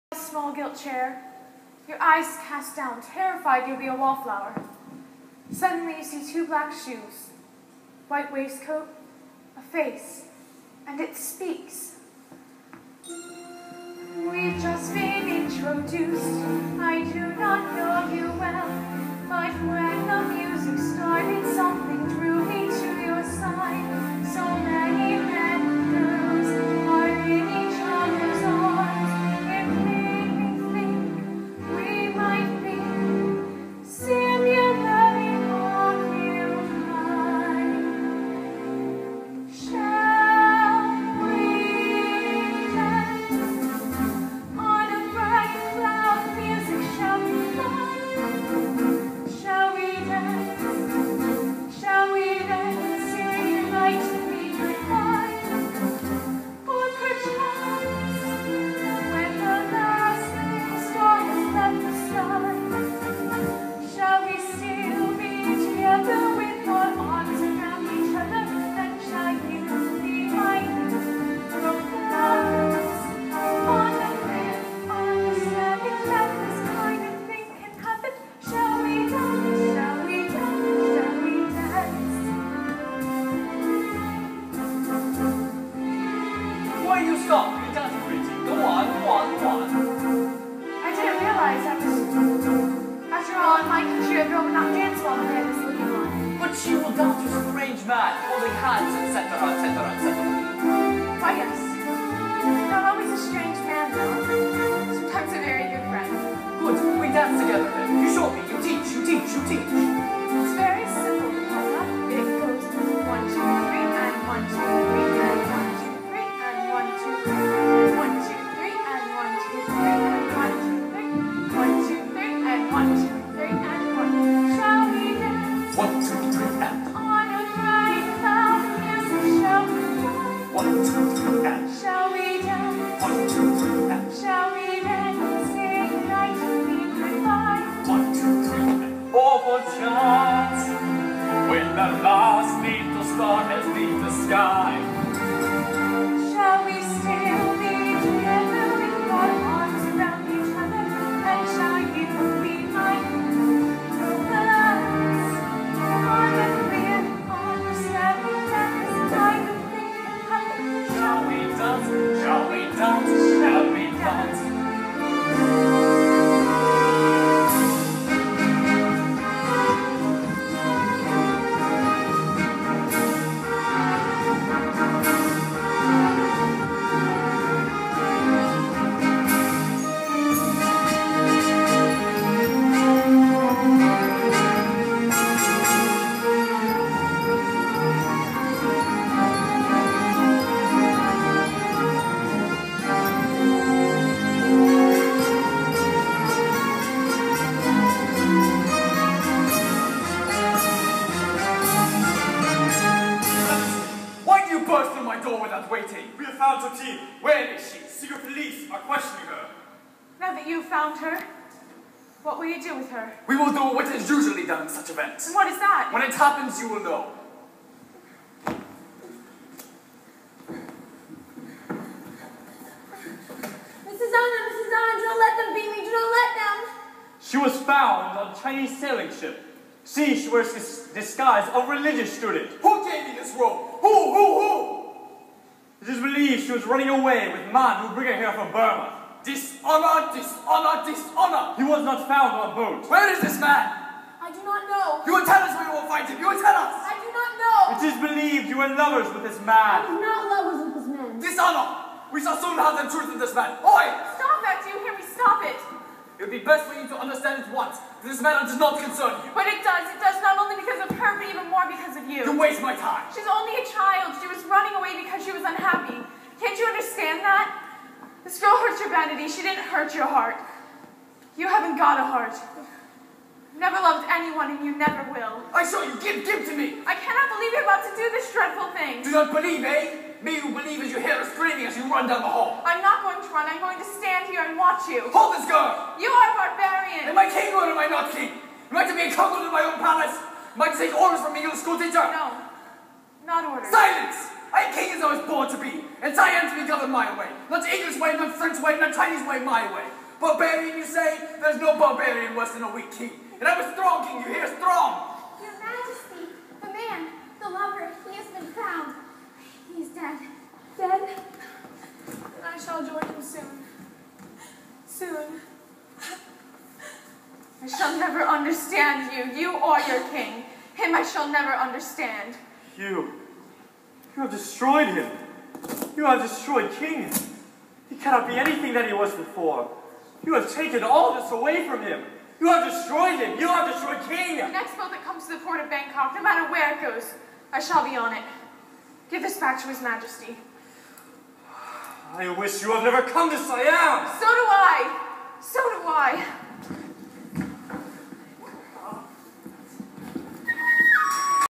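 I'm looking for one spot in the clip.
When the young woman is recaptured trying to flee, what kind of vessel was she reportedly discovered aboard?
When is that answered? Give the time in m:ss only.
3:48.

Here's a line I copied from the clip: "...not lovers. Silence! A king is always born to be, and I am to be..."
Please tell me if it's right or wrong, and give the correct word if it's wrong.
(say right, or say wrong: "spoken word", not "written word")
wrong: "orders", not "lovers".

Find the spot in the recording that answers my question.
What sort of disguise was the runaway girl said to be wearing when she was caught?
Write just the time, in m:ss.
3:51.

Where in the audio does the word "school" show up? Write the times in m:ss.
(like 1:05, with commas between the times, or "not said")
4:51.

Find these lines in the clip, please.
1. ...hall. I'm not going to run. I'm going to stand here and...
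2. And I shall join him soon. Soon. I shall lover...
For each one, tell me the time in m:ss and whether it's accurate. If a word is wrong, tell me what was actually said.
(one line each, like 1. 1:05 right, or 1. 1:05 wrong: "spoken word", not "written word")
1. 4:42 right
2. 5:12 wrong: "never", not "lover".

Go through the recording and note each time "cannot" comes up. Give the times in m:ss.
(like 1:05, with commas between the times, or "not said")
4:36, 5:27.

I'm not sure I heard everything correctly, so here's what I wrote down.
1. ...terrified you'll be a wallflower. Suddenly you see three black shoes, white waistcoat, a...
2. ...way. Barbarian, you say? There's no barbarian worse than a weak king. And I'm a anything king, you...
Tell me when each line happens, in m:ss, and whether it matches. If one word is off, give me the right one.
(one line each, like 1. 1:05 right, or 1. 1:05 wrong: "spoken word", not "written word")
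1. 0:03 wrong: "two", not "three"
2. 4:59 wrong: "strong", not "anything".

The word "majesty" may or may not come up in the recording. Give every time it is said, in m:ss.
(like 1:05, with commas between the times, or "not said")
5:05, 5:39.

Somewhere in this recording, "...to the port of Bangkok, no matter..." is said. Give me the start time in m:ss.
5:35.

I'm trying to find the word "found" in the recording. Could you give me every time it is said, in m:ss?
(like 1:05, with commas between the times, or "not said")
3:30, 3:47, 4:02, 5:08.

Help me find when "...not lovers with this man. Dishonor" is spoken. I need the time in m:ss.
4:10.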